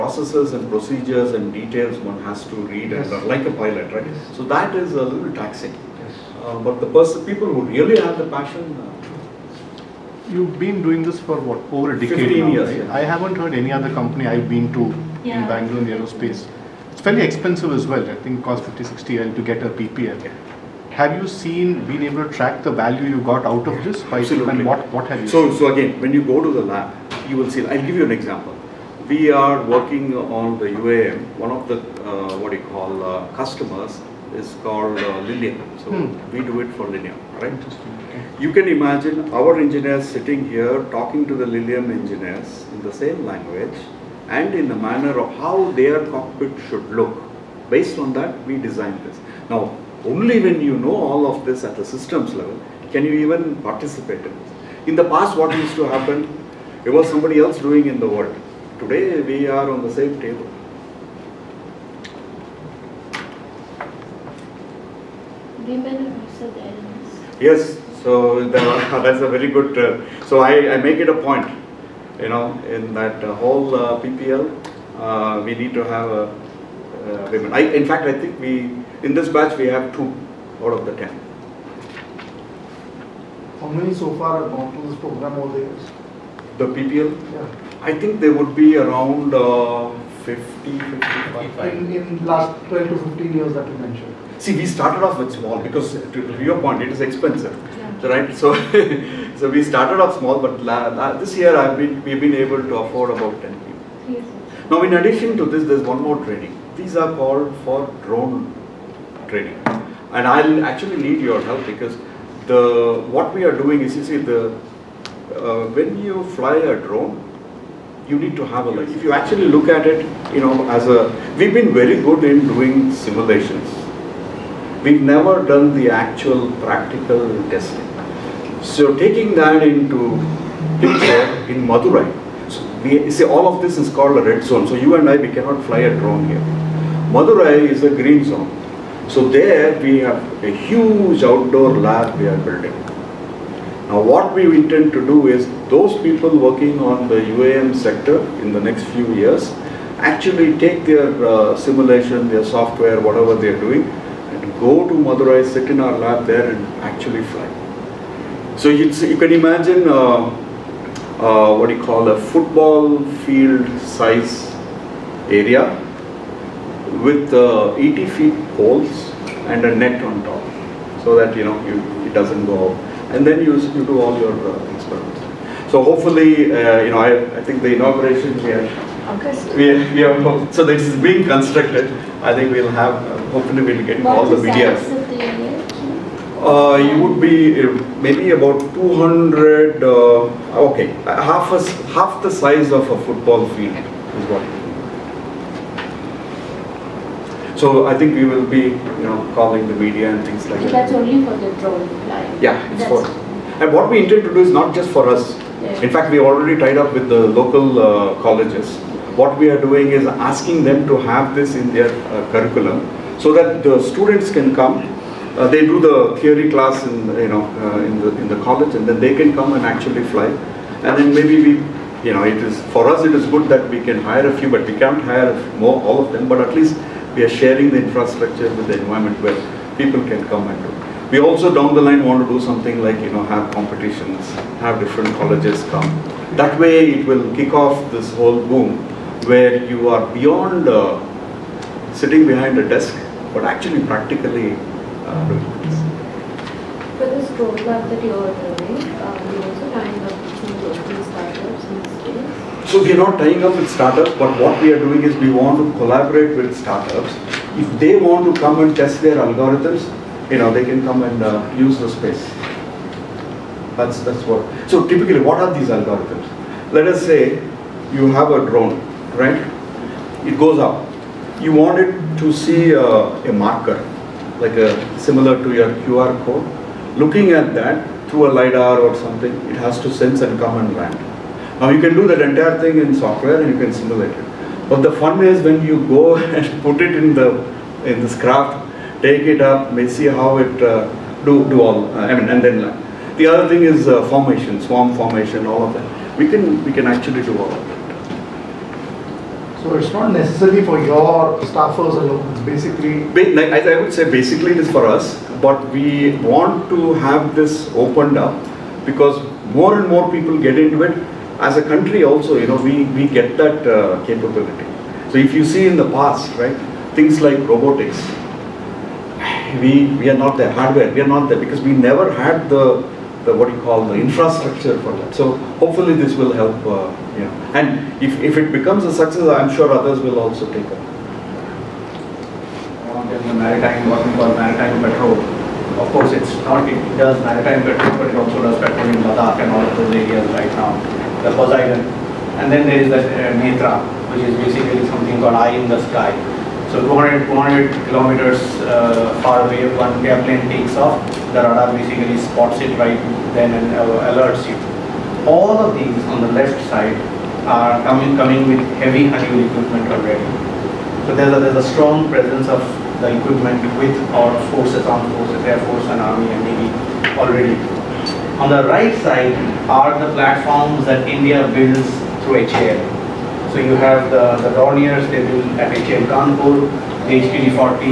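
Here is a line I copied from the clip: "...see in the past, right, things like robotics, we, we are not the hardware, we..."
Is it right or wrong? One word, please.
right.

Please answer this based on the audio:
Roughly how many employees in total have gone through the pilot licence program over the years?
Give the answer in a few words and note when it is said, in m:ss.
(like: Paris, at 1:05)
50, 55, at 1:30.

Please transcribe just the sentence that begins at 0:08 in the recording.
Uh, You've been doing this for what over a decade now, years, right?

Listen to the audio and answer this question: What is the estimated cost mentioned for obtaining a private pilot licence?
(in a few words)
50, 60 L.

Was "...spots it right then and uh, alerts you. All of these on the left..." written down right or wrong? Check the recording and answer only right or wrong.
right.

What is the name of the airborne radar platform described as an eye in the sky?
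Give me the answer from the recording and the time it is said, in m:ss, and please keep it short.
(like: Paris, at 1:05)
Netra, at 5:43.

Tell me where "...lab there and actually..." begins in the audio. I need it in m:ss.
2:35.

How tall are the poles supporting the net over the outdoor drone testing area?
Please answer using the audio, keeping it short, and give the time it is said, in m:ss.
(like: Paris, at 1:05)
80 feet, at 2:47.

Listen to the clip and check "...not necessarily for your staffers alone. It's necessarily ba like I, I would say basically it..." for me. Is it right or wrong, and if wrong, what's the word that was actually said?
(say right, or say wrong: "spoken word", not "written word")
wrong: "basically", not "necessarily".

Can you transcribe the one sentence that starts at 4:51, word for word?
Uh, I mean, and then uh, the other thing is uh, formation, swarm formation, all of that.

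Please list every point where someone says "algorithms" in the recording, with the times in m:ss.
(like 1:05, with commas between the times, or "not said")
4:19, 4:25.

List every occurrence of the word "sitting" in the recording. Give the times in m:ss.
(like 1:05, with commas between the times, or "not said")
0:40, 4:01.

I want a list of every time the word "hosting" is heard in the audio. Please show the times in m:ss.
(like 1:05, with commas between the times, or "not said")
not said.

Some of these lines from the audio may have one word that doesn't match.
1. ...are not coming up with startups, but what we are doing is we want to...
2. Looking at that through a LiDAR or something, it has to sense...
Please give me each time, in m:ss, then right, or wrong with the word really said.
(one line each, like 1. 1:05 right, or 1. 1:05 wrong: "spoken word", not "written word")
1. 4:12 wrong: "tying", not "coming"
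2. 4:36 right.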